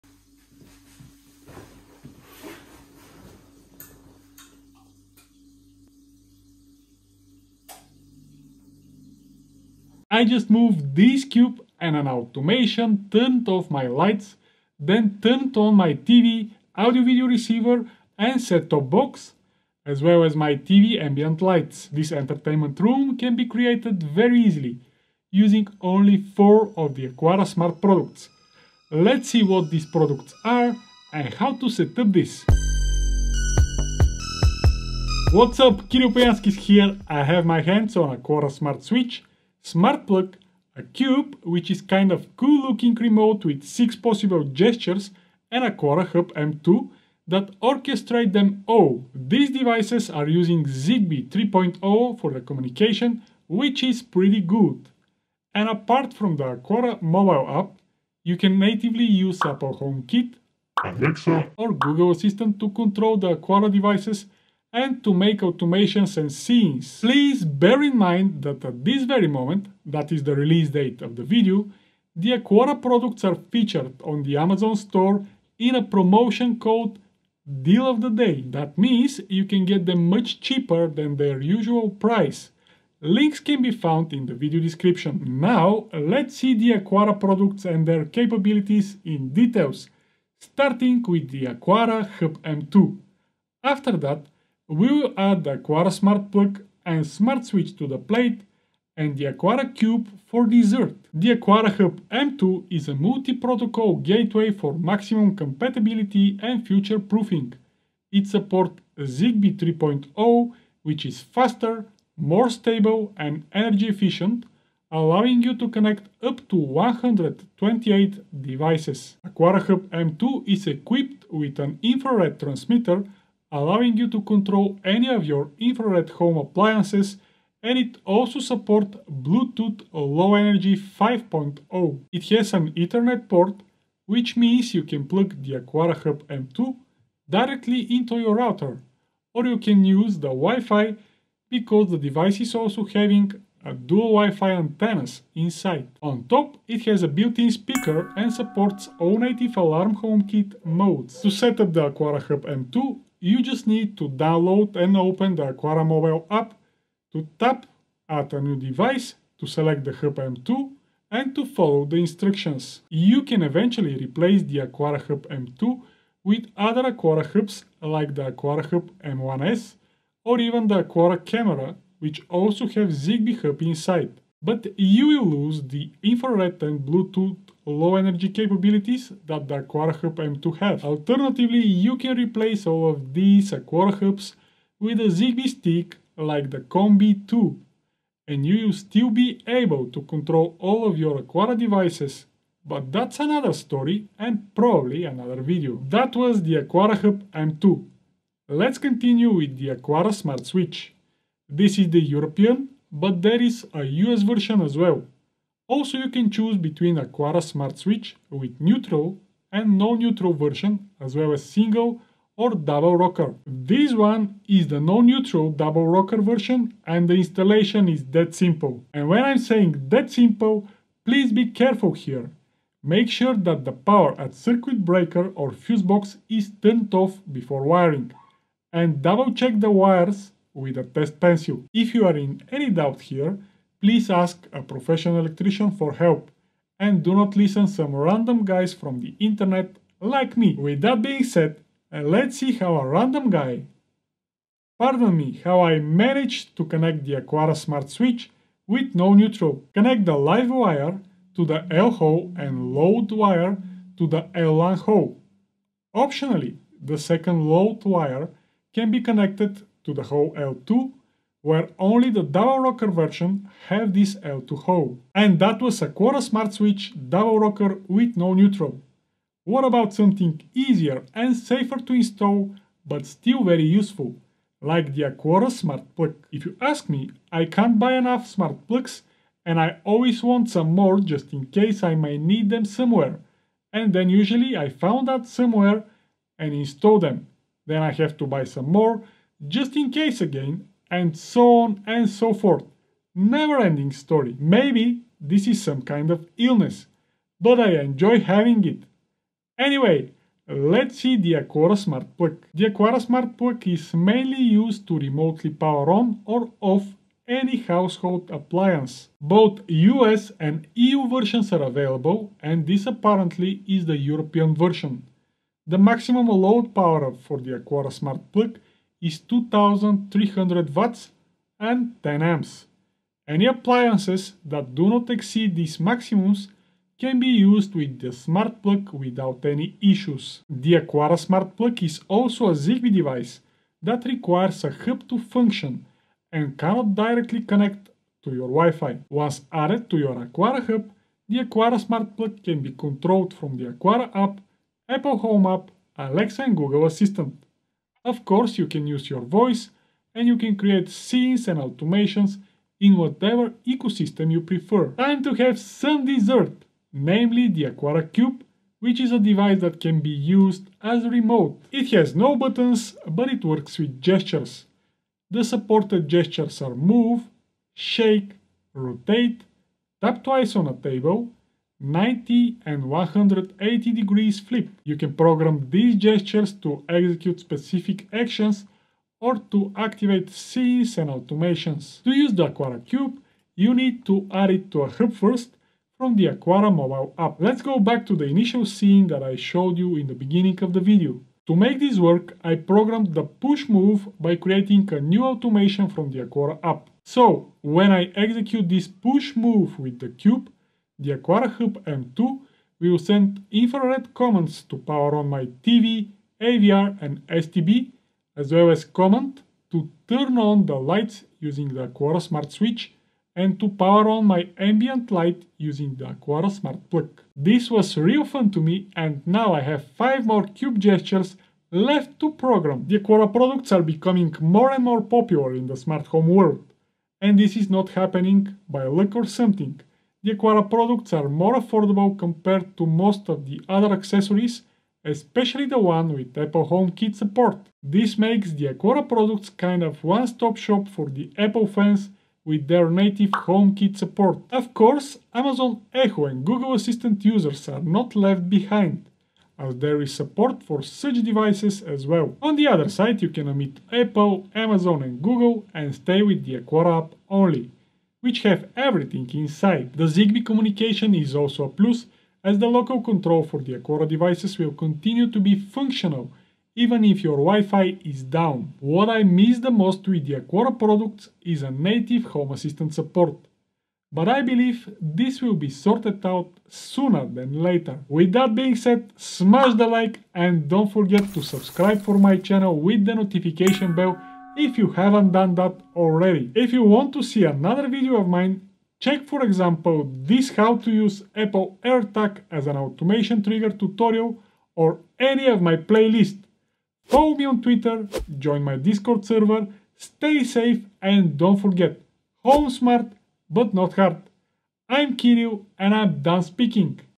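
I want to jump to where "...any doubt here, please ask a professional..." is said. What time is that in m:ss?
3:52.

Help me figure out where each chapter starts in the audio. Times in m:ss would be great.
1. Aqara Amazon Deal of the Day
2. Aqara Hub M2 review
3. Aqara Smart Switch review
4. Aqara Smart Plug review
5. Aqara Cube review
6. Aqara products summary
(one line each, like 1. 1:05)
1. 1:06
2. 1:41
3. 3:15
4. 4:25
5. 5:55
6. 7:02.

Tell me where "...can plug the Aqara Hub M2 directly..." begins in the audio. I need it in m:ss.
2:14.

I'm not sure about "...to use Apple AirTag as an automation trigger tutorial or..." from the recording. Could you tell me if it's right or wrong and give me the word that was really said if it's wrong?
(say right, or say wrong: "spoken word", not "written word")
right.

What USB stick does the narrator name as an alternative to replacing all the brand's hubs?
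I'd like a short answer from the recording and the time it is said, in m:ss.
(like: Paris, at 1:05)
ConBee 2, at 3:06.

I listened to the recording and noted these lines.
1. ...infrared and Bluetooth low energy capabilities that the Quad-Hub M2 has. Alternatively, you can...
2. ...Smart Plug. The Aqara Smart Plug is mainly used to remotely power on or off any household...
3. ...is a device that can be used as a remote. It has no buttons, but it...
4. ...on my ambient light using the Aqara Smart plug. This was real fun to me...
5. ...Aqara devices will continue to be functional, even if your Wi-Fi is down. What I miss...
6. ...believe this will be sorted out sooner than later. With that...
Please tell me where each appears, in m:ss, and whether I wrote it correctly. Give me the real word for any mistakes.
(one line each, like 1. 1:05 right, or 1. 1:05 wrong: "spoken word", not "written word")
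1. 2:56 right
2. 5:01 right
3. 5:58 right
4. 6:54 right
5. 7:43 right
6. 7:54 right.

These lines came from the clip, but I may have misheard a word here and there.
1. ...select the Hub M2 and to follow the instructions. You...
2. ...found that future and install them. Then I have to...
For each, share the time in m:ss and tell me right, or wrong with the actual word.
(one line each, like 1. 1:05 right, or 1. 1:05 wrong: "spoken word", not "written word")
1. 2:39 right
2. 4:44 wrong: "somewhere", not "future".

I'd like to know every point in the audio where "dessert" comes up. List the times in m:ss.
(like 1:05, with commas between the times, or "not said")
1:40, 5:56.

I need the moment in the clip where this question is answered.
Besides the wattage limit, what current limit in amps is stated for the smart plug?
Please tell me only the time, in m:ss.
5:22.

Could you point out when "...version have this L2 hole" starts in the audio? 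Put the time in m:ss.
4:22.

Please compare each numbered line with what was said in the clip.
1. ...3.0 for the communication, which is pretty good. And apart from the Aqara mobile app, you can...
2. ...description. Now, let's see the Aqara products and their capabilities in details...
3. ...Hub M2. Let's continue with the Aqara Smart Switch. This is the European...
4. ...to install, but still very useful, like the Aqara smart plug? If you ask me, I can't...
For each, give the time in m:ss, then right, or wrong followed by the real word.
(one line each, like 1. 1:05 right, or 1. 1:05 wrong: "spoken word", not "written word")
1. 0:51 right
2. 1:24 right
3. 3:17 right
4. 4:31 right.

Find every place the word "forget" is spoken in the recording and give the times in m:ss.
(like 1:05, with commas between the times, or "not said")
8:00, 8:21.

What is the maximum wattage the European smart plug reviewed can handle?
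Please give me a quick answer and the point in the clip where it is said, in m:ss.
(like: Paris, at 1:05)
2300 watts, at 5:19.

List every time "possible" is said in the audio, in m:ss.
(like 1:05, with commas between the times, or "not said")
0:43.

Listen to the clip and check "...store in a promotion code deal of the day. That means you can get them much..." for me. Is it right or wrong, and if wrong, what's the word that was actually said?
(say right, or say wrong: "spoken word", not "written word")
right.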